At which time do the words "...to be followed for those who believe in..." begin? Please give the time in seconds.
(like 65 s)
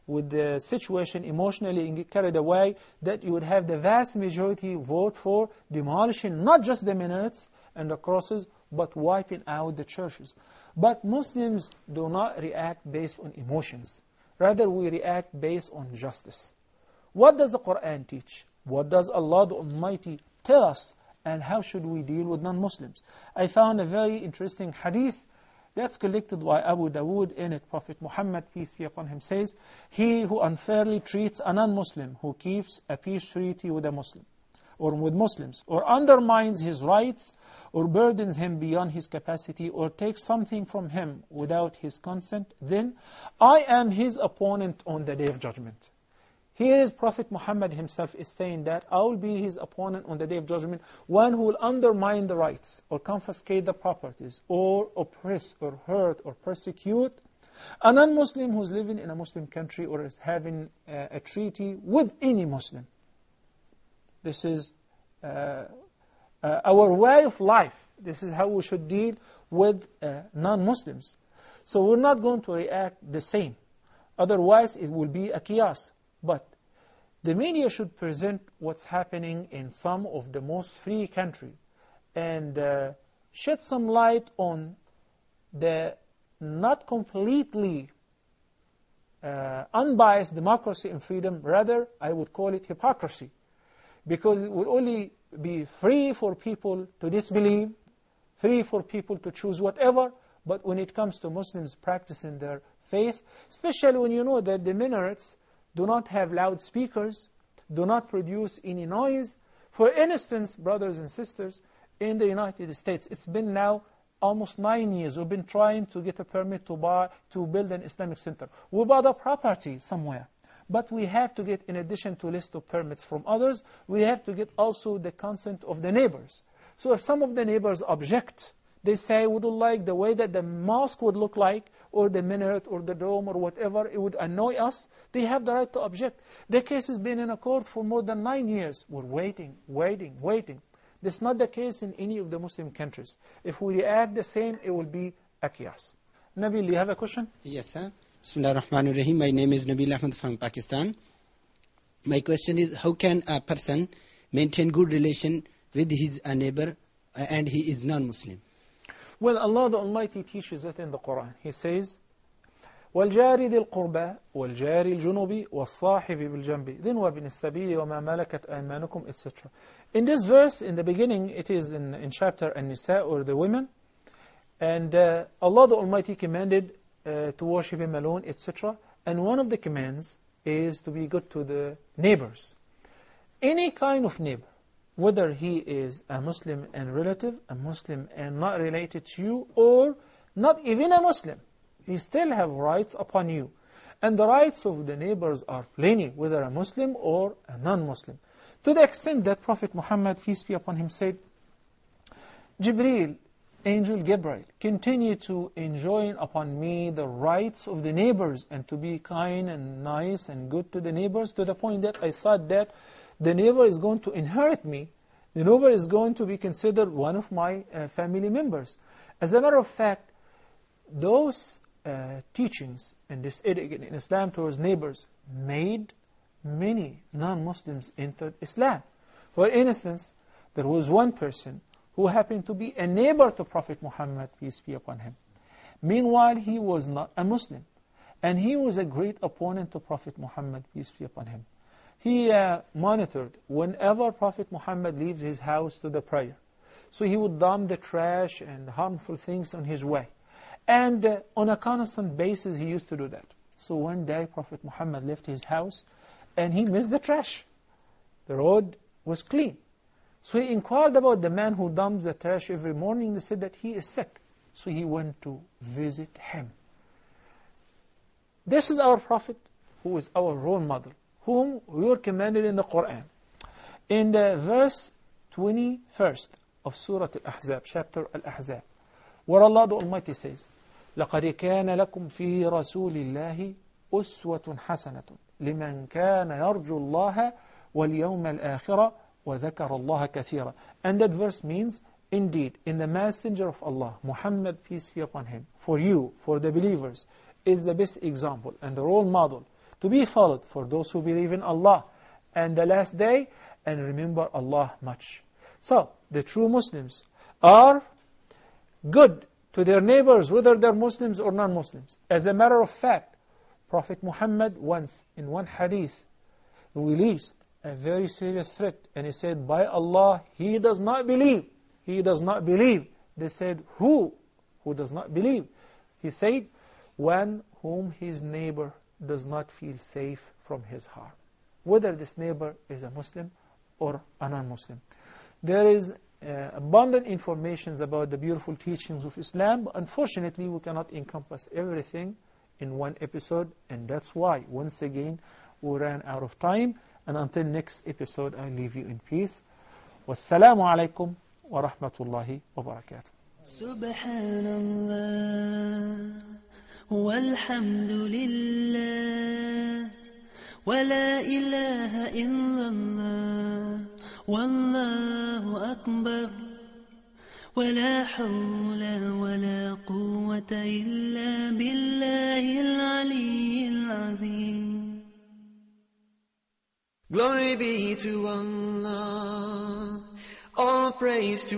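299 s.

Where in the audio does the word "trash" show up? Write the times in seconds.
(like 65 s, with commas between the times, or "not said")
247 s, 256 s, 262 s.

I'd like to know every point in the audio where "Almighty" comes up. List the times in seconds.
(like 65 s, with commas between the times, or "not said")
19 s, 159 s, 175 s, 279 s.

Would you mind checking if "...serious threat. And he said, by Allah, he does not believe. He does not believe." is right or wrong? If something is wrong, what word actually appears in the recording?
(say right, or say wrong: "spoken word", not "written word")
right.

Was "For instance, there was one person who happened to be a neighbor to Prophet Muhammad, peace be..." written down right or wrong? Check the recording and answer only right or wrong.
right.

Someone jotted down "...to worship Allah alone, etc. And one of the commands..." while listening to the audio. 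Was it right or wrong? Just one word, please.
wrong.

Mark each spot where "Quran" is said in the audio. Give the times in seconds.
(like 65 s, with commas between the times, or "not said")
17 s, 160 s, 272 s.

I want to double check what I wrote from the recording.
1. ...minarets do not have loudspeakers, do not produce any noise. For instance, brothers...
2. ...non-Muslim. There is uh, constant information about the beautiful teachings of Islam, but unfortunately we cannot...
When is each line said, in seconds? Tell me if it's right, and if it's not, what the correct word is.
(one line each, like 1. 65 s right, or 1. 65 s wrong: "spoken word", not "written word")
1. 104 s right
2. 334 s wrong: "abundant", not "constant".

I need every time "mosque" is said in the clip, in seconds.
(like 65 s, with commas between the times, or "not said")
130 s.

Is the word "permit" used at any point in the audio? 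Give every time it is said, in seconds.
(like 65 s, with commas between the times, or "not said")
116 s, 122 s.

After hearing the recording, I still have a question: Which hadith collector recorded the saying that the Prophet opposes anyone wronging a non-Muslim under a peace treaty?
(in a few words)
Abu Dawood.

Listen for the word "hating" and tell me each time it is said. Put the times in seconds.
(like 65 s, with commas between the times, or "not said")
not said.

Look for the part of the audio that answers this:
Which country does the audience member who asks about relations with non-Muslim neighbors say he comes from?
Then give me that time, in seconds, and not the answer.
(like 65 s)
150 s.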